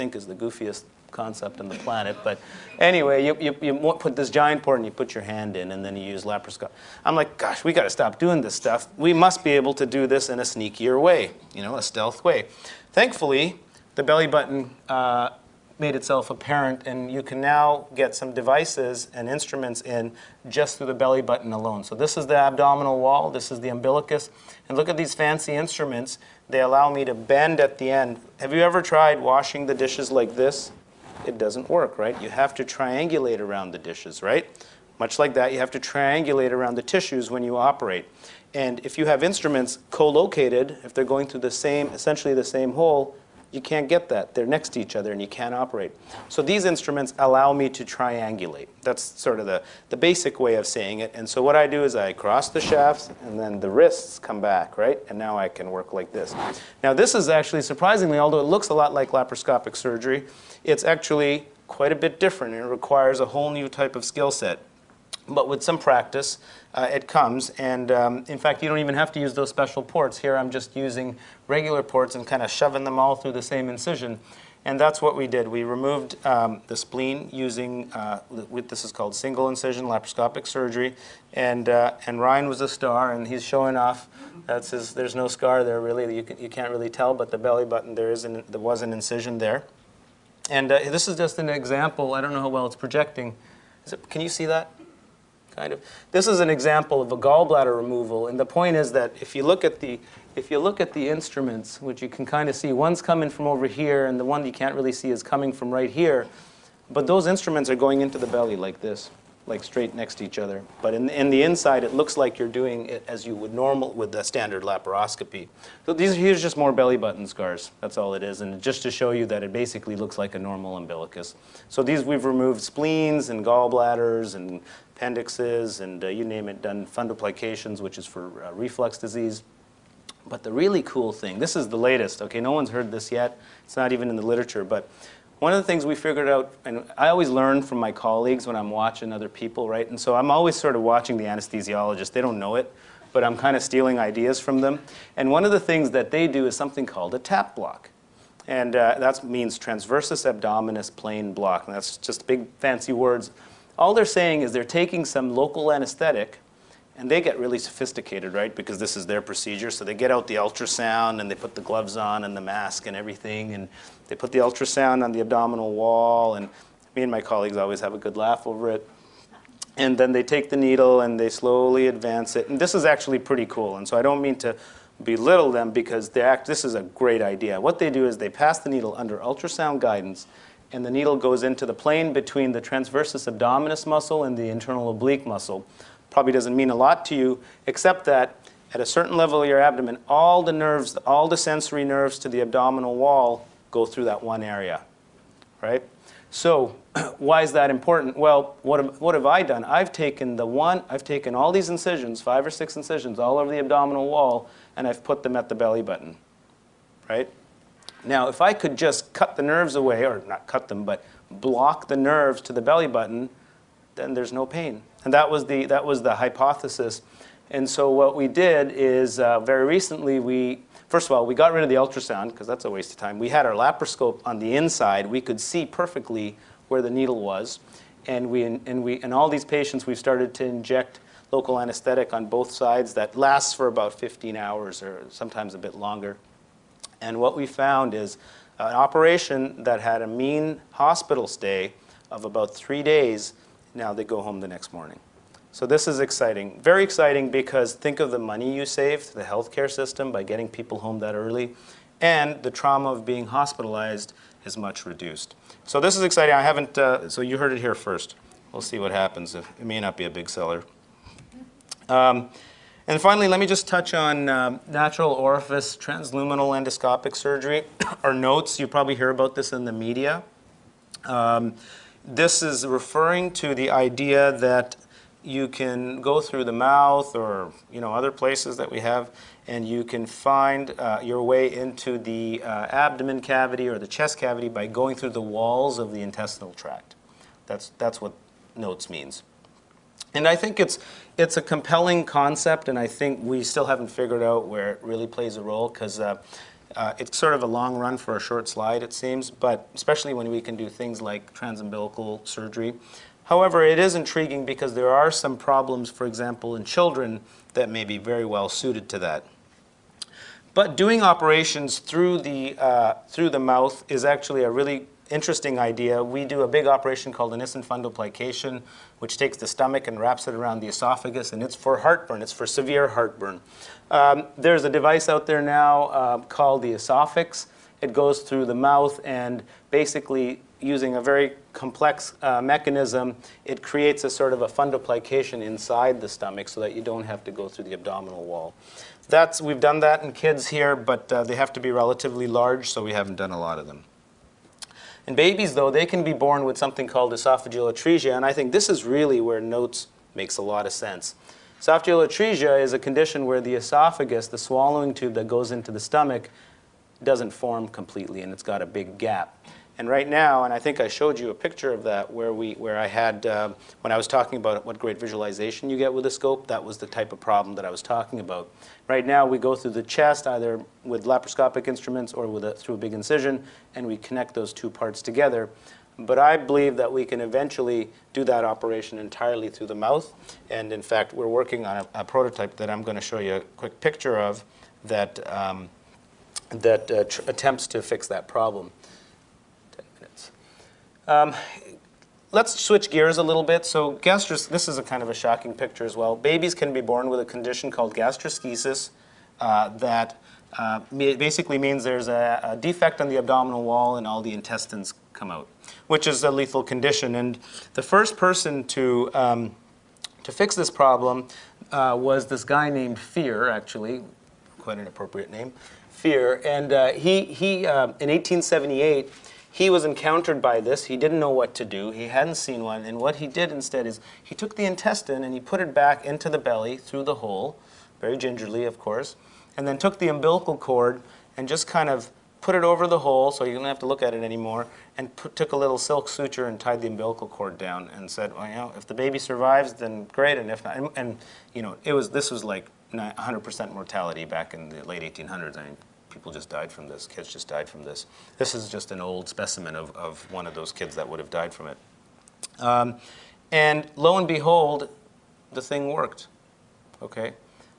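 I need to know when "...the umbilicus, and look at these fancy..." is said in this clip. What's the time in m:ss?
0:23.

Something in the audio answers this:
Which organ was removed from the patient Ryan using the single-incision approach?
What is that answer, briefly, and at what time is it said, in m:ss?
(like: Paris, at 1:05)
Spleen, at 1:16.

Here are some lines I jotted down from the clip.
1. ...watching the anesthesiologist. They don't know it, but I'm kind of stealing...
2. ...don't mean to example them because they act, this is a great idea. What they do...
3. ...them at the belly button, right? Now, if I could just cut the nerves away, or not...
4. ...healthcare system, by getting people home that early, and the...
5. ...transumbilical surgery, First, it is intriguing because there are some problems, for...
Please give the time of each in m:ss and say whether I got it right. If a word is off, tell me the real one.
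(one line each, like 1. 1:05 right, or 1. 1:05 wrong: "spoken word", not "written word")
1. 2:20 right
2. 2:54 wrong: "belittle", not "example"
3. 3:25 right
4. 4:09 right
5. 5:01 wrong: "However", not "First".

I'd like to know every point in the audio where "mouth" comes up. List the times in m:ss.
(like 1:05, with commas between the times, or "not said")
4:36, 5:13, 5:28, 6:19.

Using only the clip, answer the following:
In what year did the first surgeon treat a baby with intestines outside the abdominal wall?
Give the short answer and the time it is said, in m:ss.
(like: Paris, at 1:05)
1878, at 6:58.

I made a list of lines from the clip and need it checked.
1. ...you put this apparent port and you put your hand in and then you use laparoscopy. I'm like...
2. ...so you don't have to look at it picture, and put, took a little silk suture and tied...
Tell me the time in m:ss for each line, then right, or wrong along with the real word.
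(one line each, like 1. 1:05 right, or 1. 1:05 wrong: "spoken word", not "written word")
1. 0:03 wrong: "giant", not "apparent"
2. 7:13 wrong: "anymore", not "picture".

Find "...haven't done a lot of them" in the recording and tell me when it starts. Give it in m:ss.
5:42.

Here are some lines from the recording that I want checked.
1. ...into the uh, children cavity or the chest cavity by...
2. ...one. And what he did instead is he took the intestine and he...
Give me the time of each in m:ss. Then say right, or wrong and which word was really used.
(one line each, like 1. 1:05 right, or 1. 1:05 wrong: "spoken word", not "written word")
1. 4:41 wrong: "abdomen", not "children"
2. 7:02 right.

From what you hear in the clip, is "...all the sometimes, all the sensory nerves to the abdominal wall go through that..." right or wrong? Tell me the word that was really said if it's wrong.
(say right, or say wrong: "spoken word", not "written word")
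wrong: "nerves", not "sometimes".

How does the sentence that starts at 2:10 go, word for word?
But the really cool thing, this is the latest, okay, no one's heard this yet.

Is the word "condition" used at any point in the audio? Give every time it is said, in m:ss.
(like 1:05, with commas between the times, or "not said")
5:52, 6:37, 6:46.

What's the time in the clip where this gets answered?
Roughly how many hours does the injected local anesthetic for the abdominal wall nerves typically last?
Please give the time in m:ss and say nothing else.
3:53.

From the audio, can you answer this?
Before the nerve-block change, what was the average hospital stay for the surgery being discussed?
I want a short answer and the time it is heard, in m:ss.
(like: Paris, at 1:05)
3 days, at 4:02.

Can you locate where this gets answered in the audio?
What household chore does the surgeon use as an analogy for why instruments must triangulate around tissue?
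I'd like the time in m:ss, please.
0:29.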